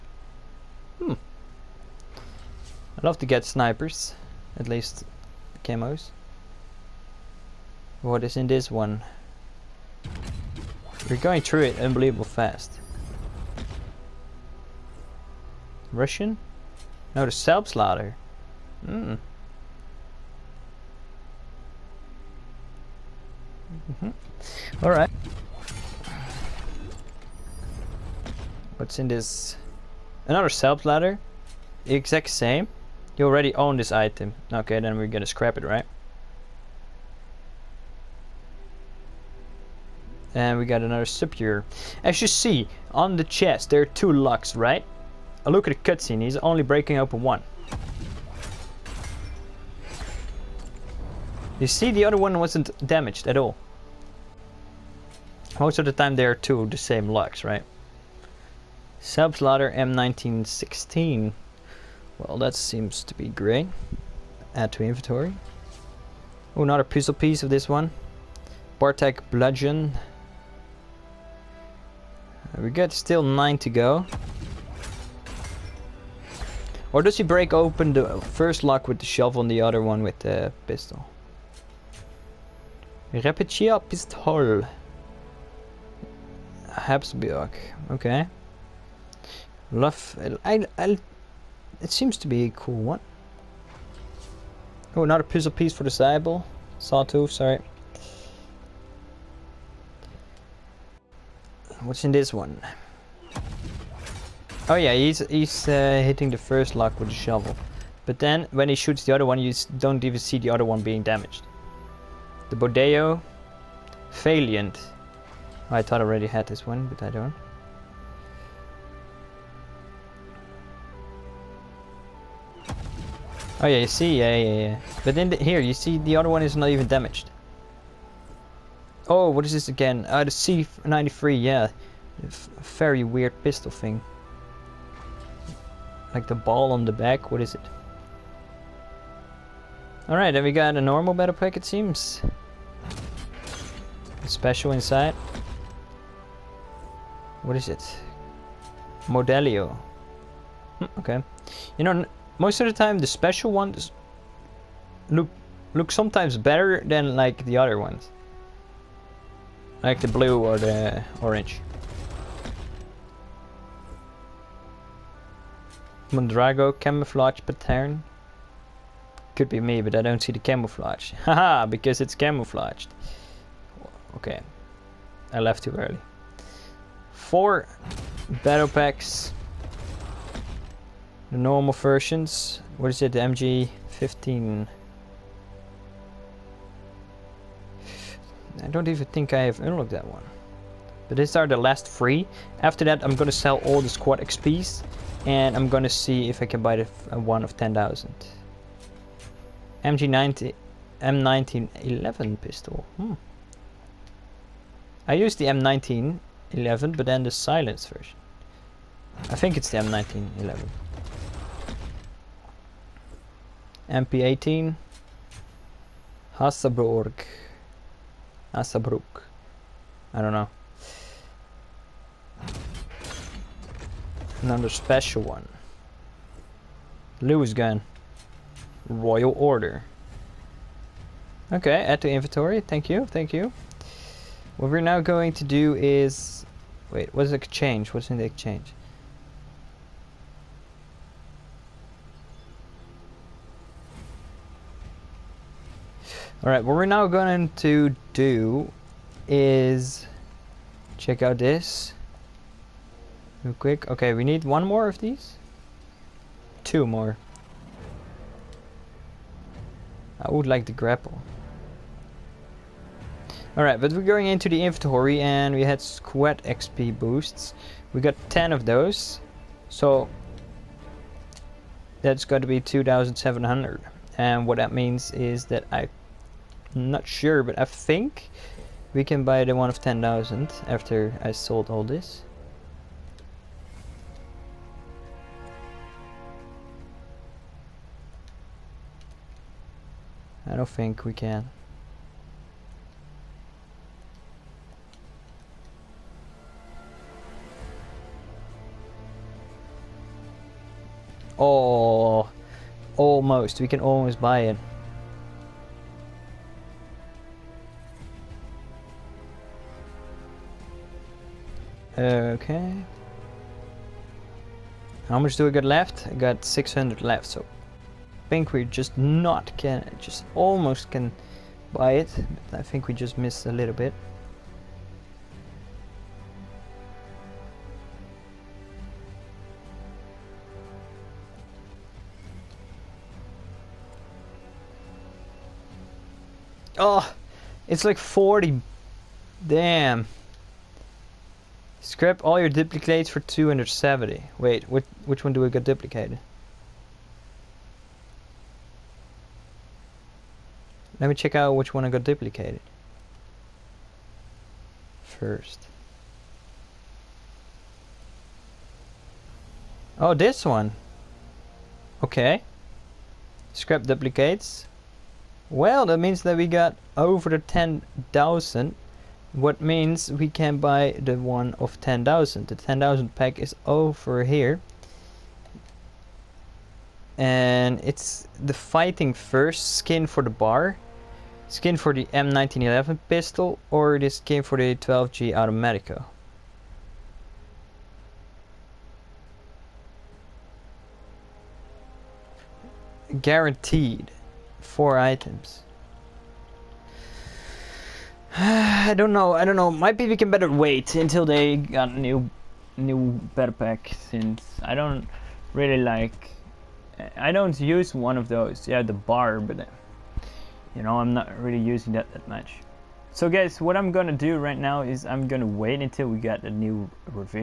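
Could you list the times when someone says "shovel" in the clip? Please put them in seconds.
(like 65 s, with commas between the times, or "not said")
79 s, 107 s.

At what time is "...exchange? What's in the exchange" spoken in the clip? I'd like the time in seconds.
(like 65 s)
237 s.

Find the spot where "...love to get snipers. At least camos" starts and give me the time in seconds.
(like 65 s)
3 s.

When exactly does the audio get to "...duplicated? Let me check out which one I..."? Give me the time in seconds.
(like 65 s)
345 s.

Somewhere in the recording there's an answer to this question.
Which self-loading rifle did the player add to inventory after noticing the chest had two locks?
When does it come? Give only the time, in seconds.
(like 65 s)
58 s.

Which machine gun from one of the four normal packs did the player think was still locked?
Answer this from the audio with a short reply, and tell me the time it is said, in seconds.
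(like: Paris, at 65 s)
MG15, at 183 s.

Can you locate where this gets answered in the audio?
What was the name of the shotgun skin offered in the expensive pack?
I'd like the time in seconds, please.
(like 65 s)
384 s.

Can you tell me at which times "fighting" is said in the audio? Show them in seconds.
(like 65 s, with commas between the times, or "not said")
378 s.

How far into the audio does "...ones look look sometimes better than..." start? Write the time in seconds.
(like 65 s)
153 s.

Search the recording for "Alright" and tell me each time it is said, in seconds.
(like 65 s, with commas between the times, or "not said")
140 s, 246 s, 263 s.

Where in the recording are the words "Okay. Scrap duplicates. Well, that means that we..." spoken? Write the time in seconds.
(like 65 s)
362 s.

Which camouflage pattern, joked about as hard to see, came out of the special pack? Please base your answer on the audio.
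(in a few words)
Mondrago.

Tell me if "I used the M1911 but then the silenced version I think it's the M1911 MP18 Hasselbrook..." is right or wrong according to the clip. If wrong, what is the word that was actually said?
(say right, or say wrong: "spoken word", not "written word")
right.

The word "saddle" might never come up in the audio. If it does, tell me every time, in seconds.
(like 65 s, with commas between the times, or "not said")
not said.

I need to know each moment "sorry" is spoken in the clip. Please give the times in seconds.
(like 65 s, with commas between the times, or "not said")
97 s.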